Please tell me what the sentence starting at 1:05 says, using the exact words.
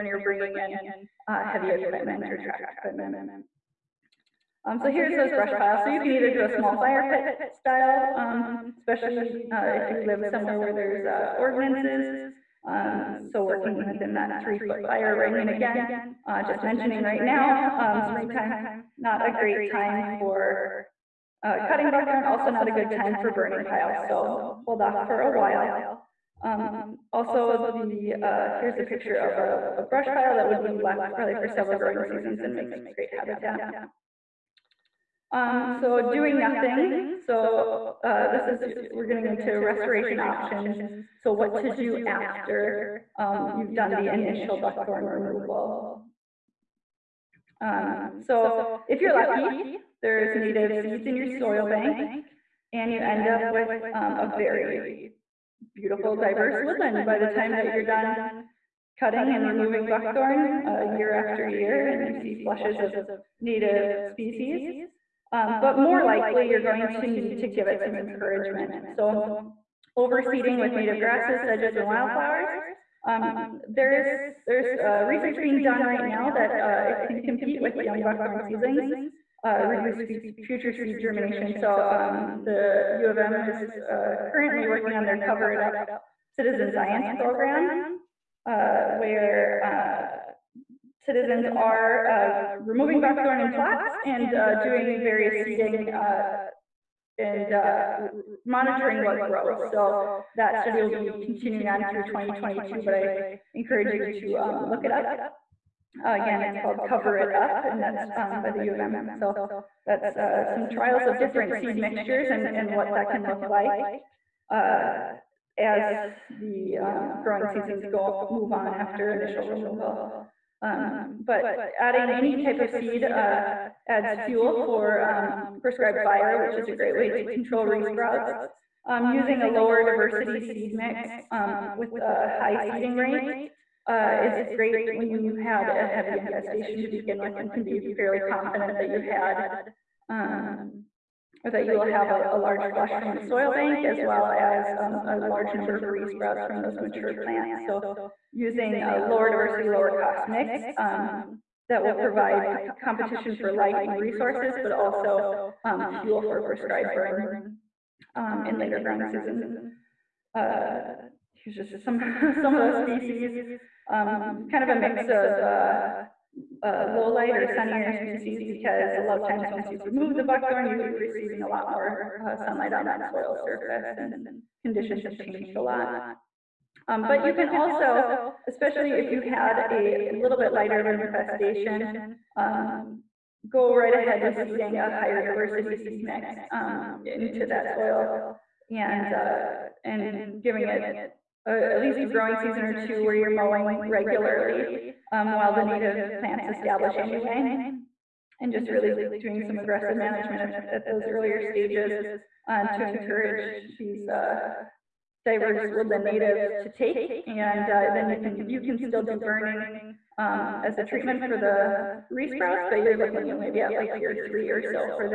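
Um, but more likely, you're going to need to give it some encouragement.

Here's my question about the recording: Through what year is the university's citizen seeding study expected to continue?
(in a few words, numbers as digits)
2022.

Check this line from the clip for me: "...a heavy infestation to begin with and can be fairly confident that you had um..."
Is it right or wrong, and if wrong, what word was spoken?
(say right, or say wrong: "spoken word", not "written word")
right.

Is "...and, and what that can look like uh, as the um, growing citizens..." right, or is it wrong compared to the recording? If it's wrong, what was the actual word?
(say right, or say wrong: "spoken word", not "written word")
wrong: "seasons", not "citizens".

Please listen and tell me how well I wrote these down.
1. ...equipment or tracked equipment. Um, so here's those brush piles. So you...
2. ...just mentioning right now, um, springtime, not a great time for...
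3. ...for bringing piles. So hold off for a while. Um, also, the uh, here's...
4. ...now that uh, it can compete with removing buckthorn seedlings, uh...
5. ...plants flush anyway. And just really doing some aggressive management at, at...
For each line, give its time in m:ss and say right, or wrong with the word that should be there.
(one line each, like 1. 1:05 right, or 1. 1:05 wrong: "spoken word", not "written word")
1. 0:01 right
2. 0:16 right
3. 0:23 wrong: "burning", not "bringing"
4. 1:16 wrong: "young", not "removing"
5. 3:16 wrong: "establish", not "flush".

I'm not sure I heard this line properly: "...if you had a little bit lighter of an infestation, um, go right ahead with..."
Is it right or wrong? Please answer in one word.
right.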